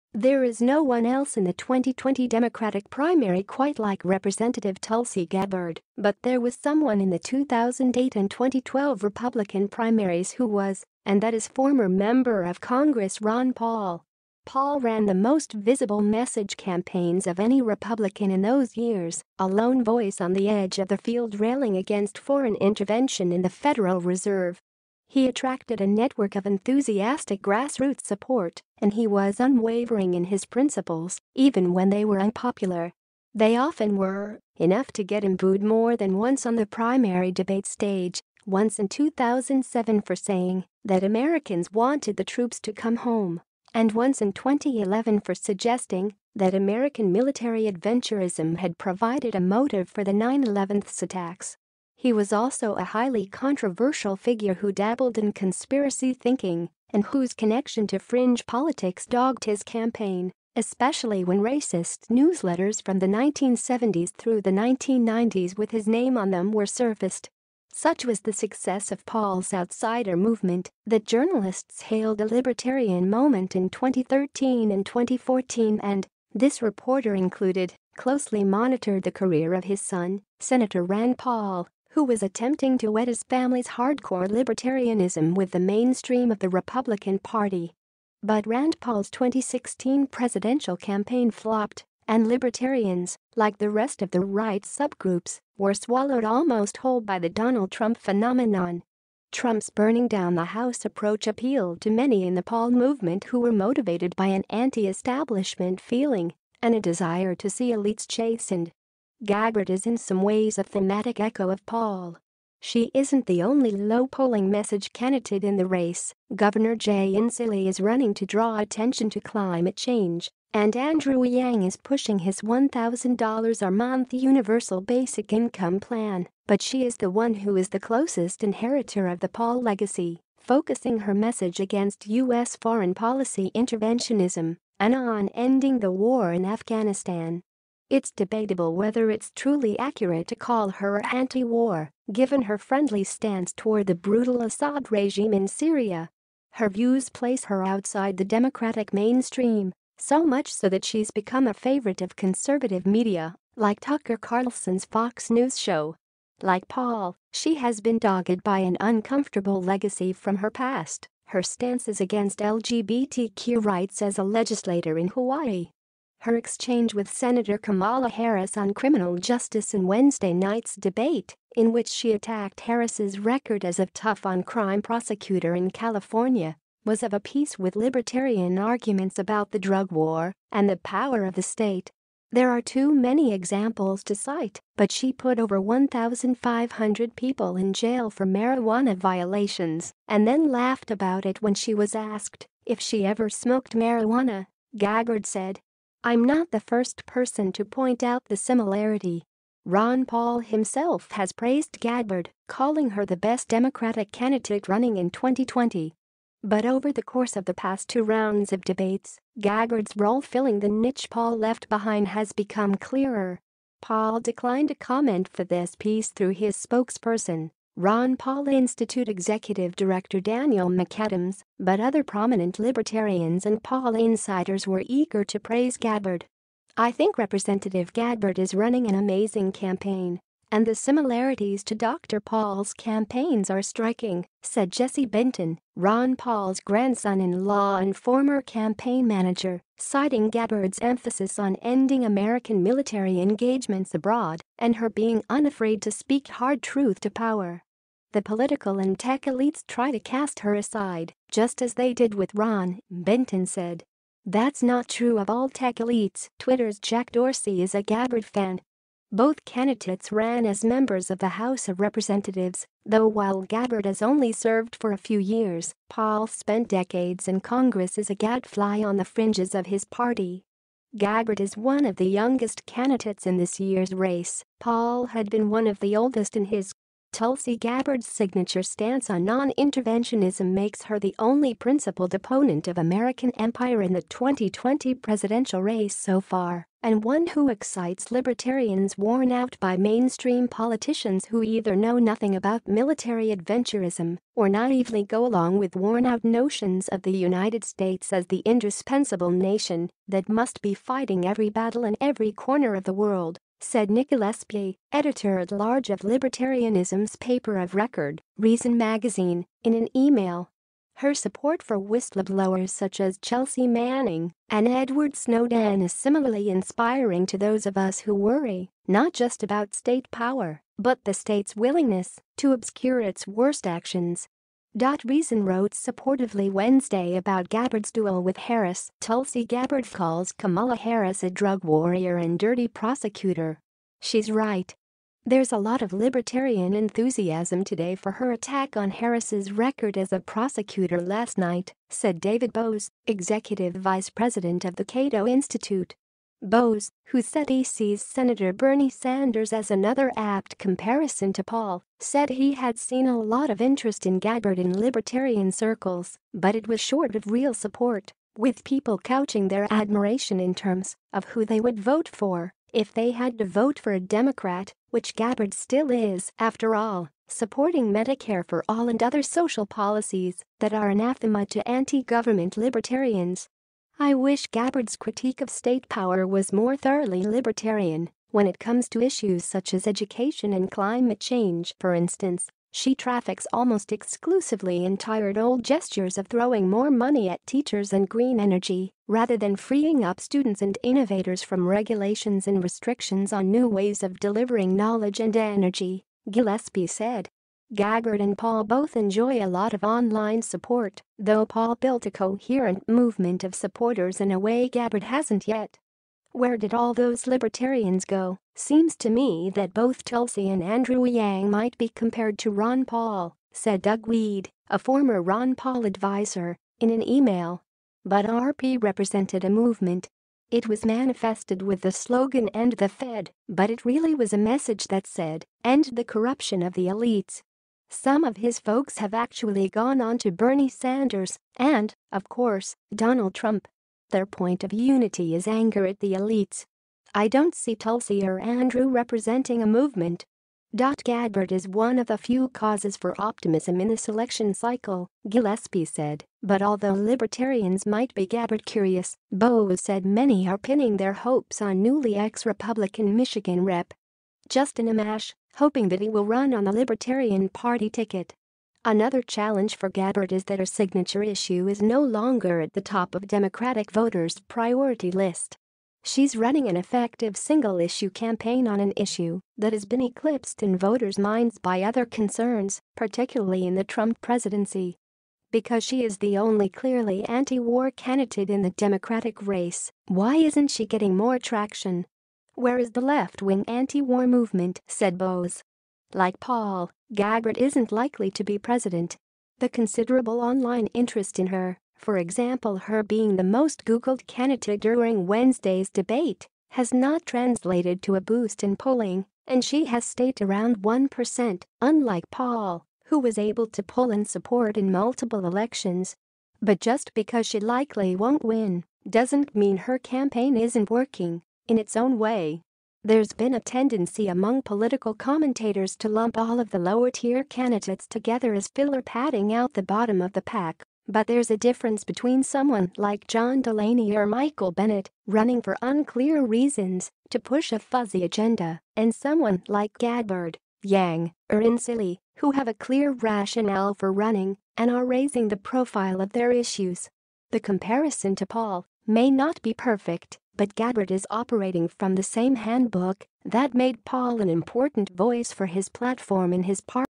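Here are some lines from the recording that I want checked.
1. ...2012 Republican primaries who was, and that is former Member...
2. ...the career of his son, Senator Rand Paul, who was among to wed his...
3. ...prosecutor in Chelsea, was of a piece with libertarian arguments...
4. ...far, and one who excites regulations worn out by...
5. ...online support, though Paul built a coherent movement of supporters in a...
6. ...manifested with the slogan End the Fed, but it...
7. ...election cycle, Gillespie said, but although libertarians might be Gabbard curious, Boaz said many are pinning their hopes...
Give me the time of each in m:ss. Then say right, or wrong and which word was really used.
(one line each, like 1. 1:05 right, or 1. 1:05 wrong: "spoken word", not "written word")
1. 0:08 right
2. 1:19 wrong: "attempting", not "among"
3. 2:54 wrong: "California", not "Chelsea"
4. 4:46 wrong: "libertarians", not "regulations"
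5. 6:39 right
6. 7:00 right
7. 7:24 right.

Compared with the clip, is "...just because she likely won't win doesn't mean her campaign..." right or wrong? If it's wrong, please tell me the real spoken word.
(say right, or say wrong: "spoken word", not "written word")
right.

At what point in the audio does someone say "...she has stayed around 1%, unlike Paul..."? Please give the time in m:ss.
8:19.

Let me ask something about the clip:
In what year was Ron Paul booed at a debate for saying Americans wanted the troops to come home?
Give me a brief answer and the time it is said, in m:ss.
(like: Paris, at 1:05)
2007, at 0:38.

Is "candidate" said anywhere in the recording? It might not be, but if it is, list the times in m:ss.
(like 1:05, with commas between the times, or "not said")
1:54, 3:24, 4:19, 4:32, 7:57, 8:14, 8:37.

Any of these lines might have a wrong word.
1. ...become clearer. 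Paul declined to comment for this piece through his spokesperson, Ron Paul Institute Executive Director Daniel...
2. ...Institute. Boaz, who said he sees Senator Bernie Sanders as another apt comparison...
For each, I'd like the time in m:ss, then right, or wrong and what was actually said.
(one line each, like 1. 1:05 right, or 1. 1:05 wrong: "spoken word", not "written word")
1. 3:32 right
2. 5:45 right.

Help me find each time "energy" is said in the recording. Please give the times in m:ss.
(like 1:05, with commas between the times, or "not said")
6:28, 6:35.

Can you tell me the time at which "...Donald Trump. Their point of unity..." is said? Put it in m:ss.
7:12.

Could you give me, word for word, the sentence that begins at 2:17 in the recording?
It's debatable whether it's truly accurate to call her anti-war, given her friendly stance toward the brutal Assad regime in Syria.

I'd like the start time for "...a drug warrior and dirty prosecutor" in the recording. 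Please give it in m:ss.
5:31.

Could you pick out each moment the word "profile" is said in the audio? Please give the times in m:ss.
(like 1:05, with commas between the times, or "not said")
8:55.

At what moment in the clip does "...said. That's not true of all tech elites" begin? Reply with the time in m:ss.
4:13.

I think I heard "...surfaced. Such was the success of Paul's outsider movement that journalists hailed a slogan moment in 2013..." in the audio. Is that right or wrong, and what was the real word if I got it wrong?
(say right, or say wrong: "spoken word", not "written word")
wrong: "libertarian", not "slogan".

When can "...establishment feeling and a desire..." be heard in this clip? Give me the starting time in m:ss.
1:44.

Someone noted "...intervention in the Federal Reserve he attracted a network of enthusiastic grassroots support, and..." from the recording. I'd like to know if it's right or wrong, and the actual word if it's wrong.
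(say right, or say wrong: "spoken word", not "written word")
right.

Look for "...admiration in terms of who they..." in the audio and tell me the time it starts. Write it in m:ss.
5:59.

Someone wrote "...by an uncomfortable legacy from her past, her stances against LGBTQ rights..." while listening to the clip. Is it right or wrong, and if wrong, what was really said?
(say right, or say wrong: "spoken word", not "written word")
right.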